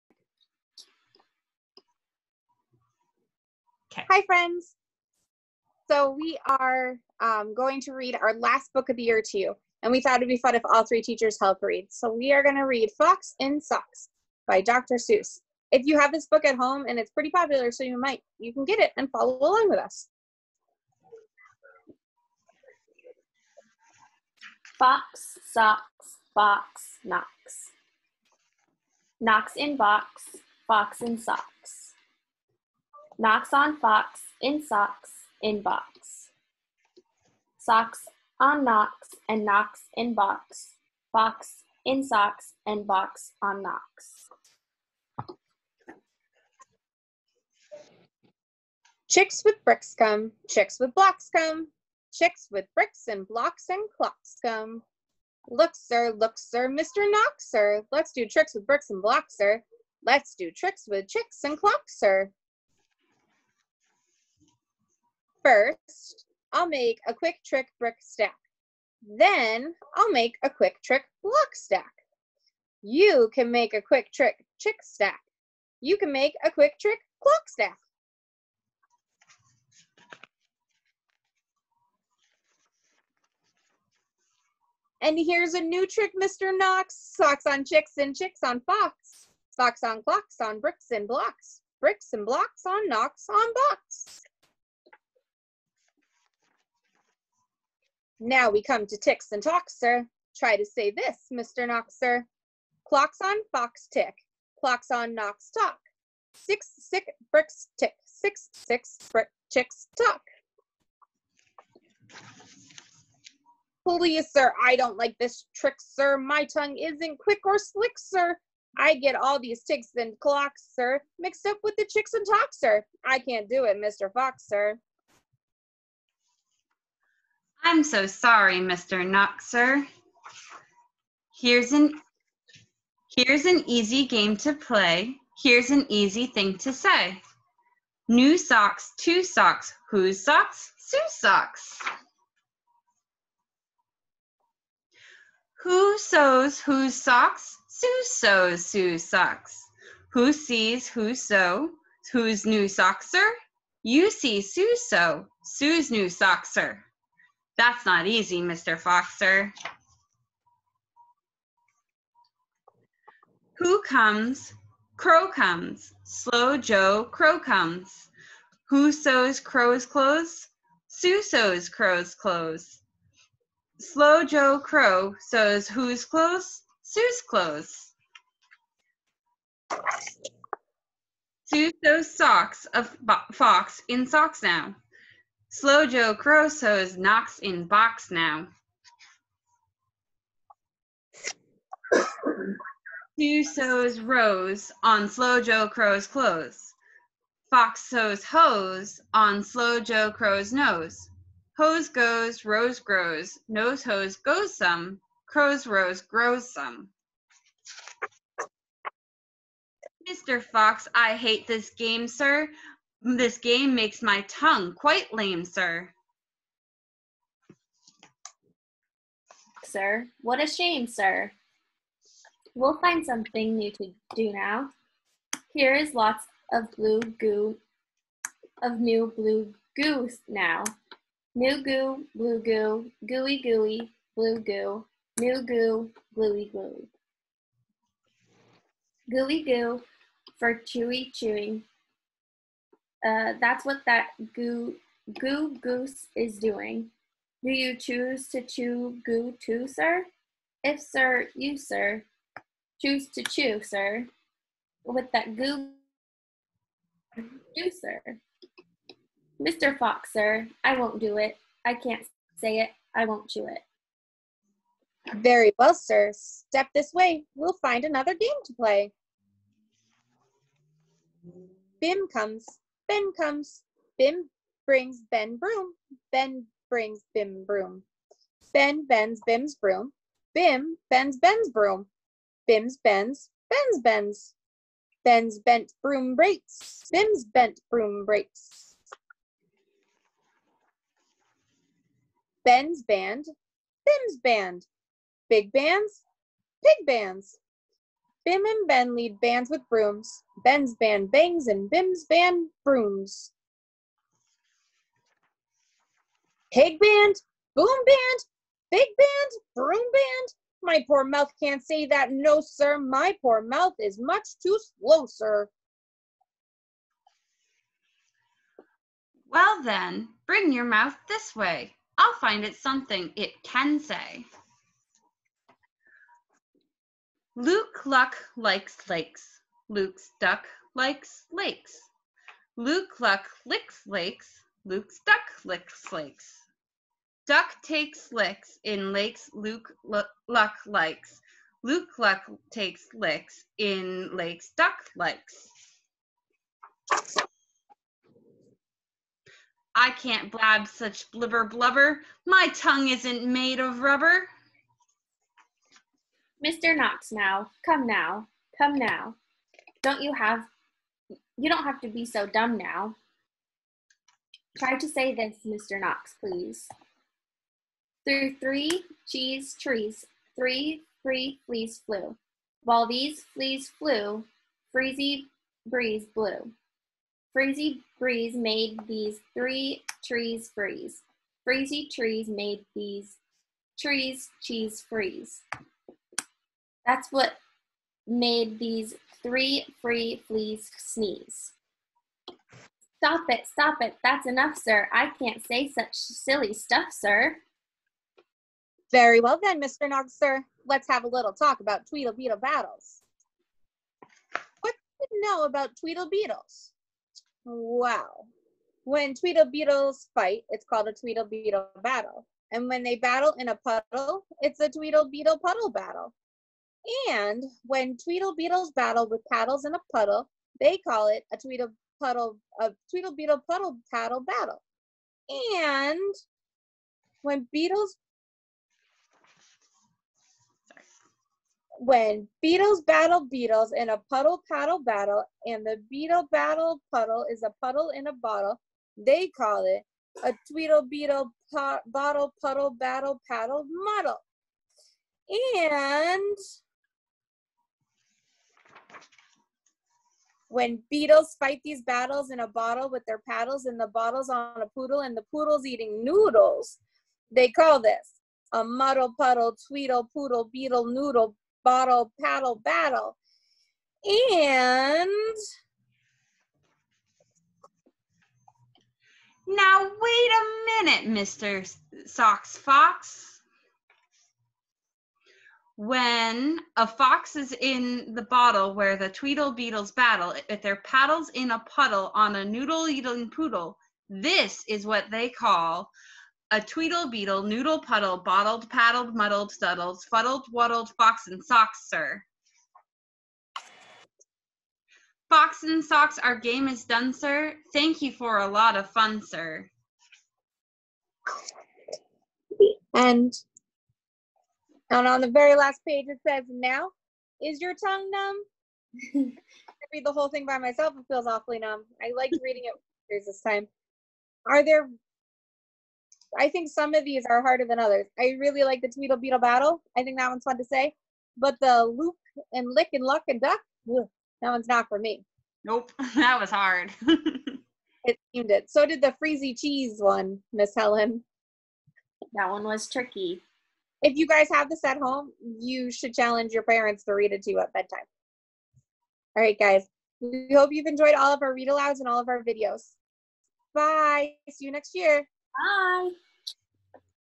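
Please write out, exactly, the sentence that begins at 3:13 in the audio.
Two sews rose on Slow Joe Crow's clothes.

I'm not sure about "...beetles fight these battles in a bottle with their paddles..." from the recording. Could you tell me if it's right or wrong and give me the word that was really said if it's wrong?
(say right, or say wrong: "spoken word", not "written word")
right.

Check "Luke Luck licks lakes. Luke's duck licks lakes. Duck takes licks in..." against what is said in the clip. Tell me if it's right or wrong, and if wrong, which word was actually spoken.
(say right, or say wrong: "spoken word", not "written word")
right.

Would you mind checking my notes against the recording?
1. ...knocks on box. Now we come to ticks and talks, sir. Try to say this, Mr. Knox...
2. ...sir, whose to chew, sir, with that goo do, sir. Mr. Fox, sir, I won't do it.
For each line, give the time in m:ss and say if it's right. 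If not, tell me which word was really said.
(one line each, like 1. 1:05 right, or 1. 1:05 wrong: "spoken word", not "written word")
1. 1:32 right
2. 4:11 wrong: "choose", not "whose".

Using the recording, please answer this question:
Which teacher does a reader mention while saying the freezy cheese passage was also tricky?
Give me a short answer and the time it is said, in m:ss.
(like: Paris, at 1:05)
Miss Helen, at 8:50.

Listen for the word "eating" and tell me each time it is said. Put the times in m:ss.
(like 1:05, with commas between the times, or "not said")
7:35, 8:02.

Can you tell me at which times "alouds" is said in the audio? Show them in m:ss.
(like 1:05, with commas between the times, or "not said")
9:01.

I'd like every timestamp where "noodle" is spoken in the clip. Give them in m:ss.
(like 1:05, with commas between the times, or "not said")
7:36, 7:40, 8:02, 8:07.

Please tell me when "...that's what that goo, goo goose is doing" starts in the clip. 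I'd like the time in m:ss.
4:03.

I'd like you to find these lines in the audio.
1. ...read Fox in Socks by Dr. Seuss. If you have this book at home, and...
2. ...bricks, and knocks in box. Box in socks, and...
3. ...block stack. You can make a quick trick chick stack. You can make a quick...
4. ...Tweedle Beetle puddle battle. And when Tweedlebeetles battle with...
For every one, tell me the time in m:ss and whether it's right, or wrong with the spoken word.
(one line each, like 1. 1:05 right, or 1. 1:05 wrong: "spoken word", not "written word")
1. 0:12 right
2. 0:38 wrong: "knocks", not "bricks"
3. 1:11 right
4. 6:54 right.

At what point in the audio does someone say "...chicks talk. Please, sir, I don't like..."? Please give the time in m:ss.
1:49.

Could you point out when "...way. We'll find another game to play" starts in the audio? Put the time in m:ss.
4:26.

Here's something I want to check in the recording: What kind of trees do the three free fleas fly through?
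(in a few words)
Cheese trees.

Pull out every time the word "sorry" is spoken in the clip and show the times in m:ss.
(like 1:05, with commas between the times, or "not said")
2:08, 7:10.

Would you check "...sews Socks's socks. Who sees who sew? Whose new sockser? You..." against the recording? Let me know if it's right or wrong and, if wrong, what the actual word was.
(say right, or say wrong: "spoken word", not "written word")
wrong: "Sue", not "Socks".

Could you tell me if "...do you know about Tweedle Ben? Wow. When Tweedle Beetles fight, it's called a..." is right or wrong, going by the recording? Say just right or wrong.
wrong.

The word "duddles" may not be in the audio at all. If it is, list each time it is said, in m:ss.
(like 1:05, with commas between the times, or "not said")
8:09.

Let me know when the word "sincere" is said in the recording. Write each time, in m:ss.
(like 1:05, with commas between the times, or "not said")
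not said.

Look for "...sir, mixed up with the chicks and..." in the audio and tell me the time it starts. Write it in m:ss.
2:00.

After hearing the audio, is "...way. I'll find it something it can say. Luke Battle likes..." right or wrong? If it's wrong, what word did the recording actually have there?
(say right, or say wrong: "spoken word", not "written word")
wrong: "Luck", not "Battle".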